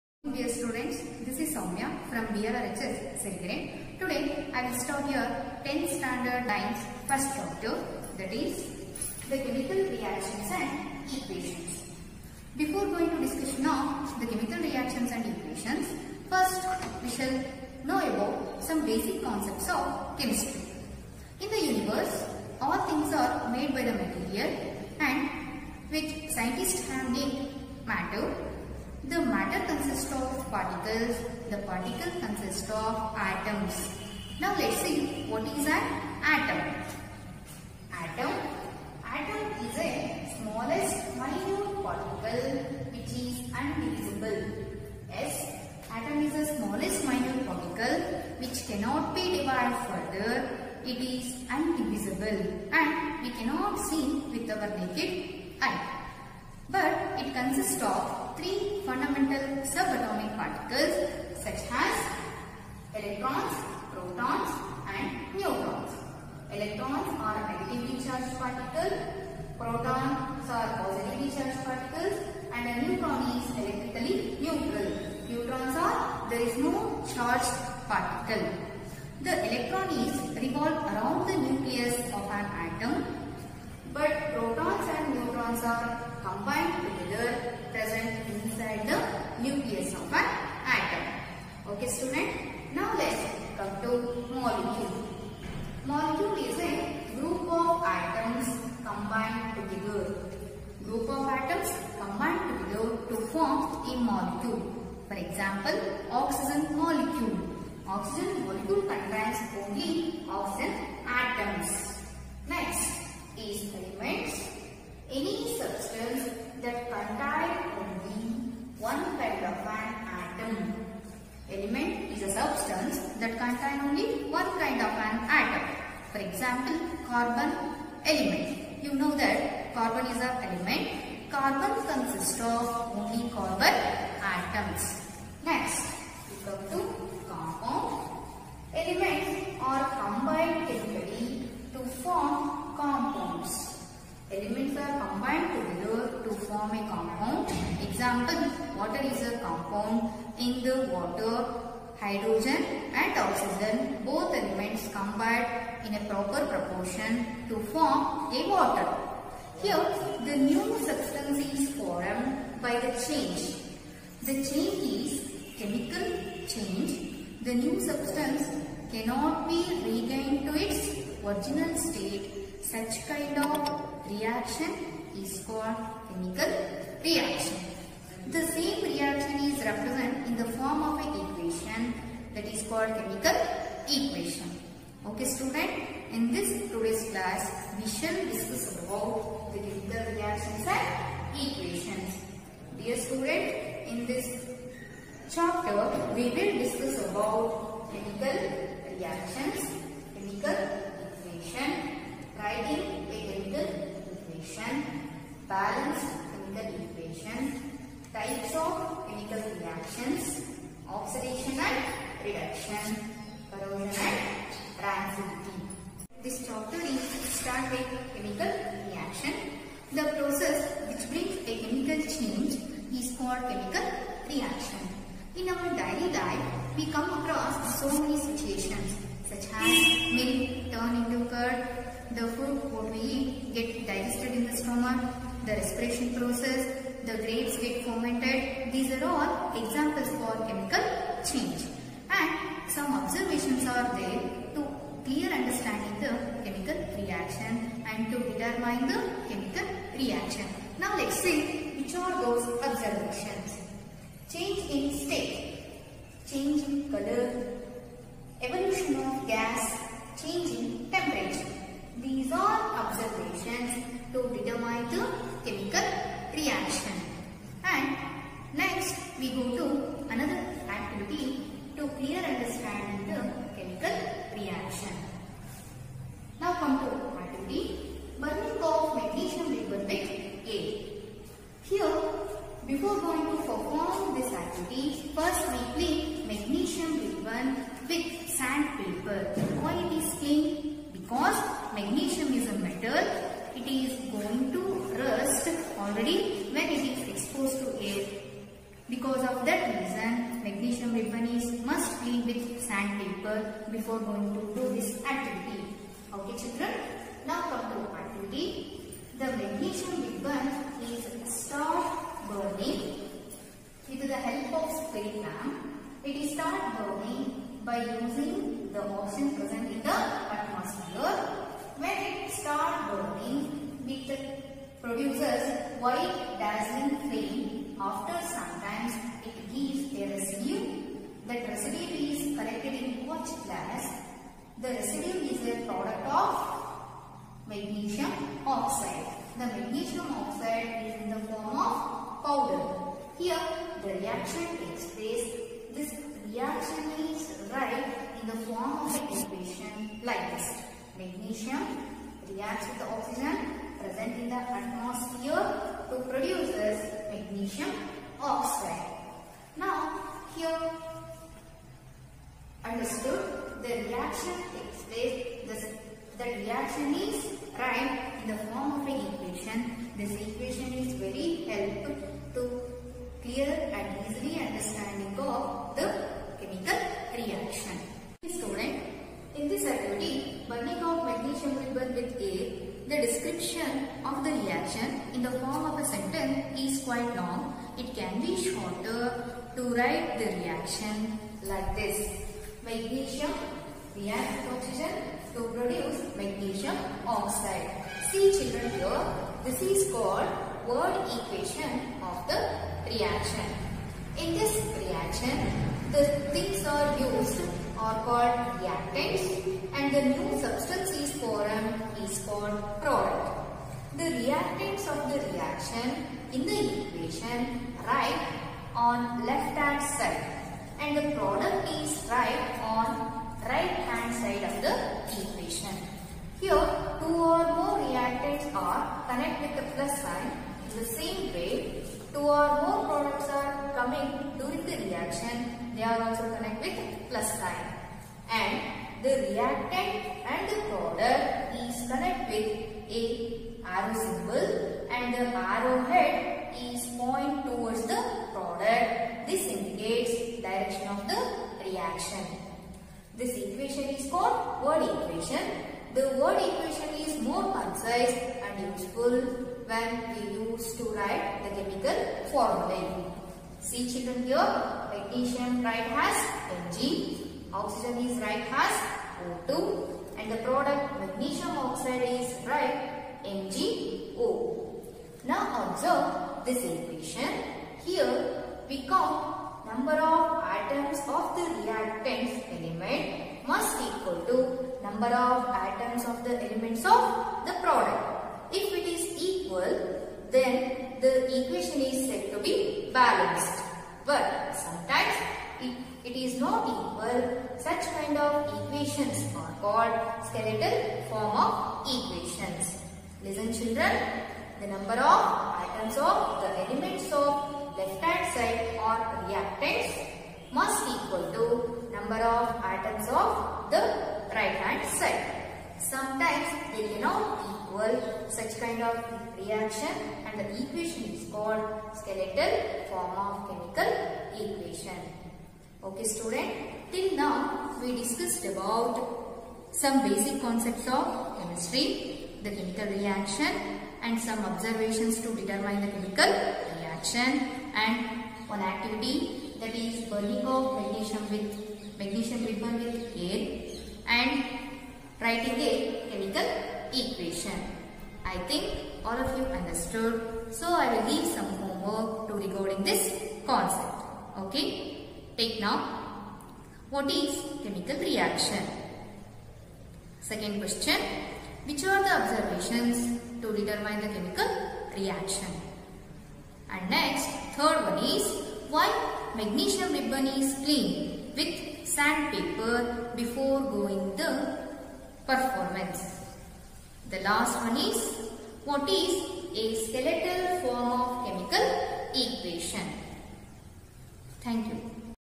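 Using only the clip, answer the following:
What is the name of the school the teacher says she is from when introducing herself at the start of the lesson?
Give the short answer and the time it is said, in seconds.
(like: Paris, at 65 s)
BLRHS Sirigere, at 2 s.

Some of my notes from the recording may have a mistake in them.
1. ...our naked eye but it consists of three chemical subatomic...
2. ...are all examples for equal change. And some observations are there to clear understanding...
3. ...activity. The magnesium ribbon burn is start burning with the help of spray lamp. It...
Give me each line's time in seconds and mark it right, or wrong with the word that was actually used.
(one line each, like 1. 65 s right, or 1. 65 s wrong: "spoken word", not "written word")
1. 54 s wrong: "fundamental", not "chemical"
2. 238 s wrong: "chemical", not "equal"
3. 307 s right.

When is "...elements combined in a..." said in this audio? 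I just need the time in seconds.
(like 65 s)
154 s.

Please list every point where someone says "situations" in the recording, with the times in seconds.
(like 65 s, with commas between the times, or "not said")
228 s.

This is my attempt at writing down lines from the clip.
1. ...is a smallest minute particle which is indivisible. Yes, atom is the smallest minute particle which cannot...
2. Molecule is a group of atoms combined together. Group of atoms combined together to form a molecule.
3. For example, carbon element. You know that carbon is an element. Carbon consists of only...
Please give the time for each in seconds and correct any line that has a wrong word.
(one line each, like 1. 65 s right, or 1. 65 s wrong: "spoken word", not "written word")
1. 39 s right
2. 95 s right
3. 126 s right.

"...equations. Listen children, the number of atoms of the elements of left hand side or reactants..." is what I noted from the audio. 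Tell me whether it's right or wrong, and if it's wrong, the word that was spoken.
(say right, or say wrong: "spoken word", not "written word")
right.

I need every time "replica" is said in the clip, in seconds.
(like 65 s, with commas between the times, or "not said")
not said.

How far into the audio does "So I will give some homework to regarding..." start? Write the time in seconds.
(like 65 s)
550 s.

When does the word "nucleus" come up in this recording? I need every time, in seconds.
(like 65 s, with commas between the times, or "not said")
81 s, 89 s.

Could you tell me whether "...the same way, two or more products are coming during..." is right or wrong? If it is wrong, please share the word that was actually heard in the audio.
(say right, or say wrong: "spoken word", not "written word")
right.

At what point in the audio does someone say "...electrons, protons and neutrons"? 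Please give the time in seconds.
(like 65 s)
62 s.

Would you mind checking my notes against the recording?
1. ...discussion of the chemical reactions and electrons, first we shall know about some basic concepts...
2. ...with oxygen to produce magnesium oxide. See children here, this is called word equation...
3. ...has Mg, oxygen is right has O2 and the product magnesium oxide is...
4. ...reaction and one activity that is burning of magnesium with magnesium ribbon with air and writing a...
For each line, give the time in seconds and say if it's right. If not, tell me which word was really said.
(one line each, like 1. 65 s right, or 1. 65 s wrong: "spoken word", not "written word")
1. 13 s wrong: "equations", not "electrons"
2. 394 s right
3. 465 s right
4. 536 s right.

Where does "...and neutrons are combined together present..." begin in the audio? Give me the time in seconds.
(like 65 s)
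84 s.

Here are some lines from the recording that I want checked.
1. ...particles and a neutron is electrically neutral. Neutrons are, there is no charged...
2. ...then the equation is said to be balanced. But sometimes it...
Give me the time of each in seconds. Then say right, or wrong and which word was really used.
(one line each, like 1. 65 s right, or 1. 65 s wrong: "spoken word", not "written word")
1. 71 s right
2. 490 s right.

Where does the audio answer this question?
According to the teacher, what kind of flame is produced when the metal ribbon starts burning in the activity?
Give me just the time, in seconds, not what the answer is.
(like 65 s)
325 s.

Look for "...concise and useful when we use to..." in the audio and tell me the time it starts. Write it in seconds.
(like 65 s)
457 s.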